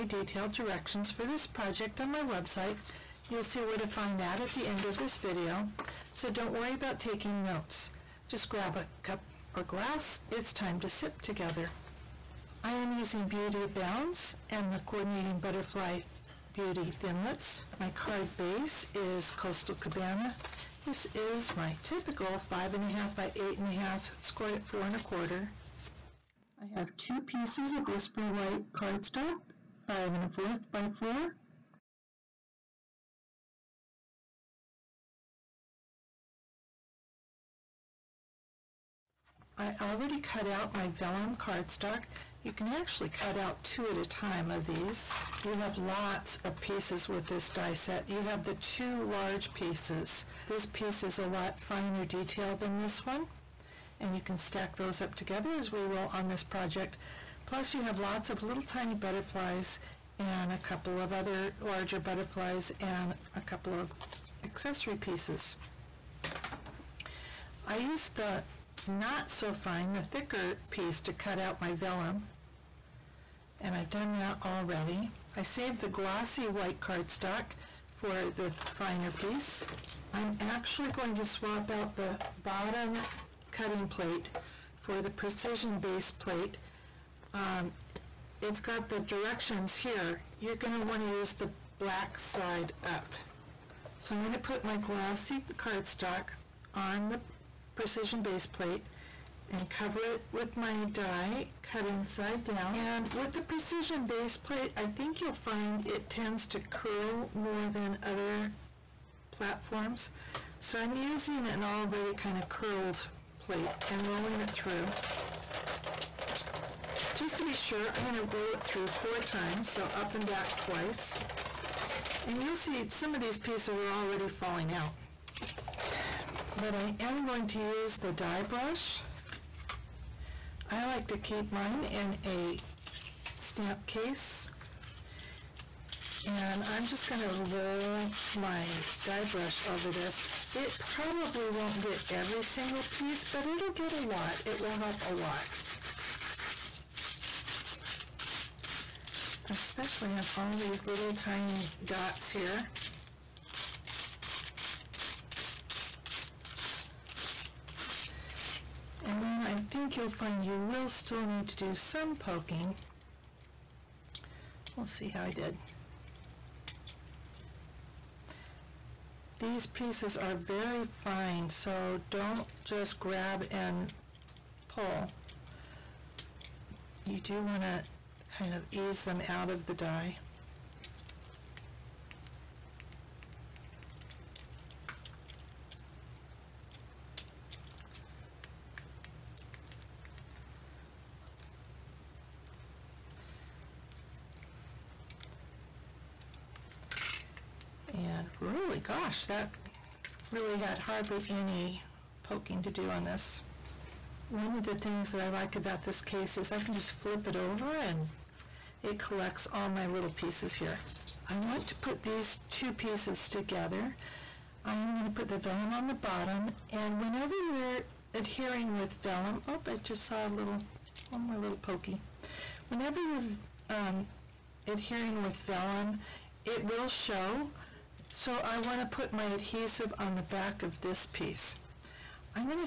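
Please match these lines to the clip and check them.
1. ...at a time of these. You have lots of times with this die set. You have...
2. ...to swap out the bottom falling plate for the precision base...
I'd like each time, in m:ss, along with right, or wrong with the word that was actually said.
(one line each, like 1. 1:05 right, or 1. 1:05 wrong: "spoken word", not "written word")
1. 0:43 wrong: "pieces", not "times"
2. 1:21 wrong: "cutting", not "falling".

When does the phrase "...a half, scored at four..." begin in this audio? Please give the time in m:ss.
0:23.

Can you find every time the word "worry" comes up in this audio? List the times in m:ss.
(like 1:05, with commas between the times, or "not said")
0:06.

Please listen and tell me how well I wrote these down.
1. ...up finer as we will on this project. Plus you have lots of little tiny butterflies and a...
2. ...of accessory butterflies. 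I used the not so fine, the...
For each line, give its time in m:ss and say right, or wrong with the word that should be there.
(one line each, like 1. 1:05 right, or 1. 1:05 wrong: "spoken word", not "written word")
1. 0:55 wrong: "together", not "finer"
2. 1:03 wrong: "pieces", not "butterflies".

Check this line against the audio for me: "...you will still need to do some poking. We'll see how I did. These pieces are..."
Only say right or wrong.
right.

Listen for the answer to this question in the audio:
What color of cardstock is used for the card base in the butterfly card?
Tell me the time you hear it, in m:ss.
0:19.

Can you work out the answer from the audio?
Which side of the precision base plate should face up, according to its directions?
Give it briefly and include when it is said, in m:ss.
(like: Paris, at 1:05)
Black side, at 1:31.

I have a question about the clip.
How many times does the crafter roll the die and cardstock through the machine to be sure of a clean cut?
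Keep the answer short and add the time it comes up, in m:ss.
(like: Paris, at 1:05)
4, at 1:58.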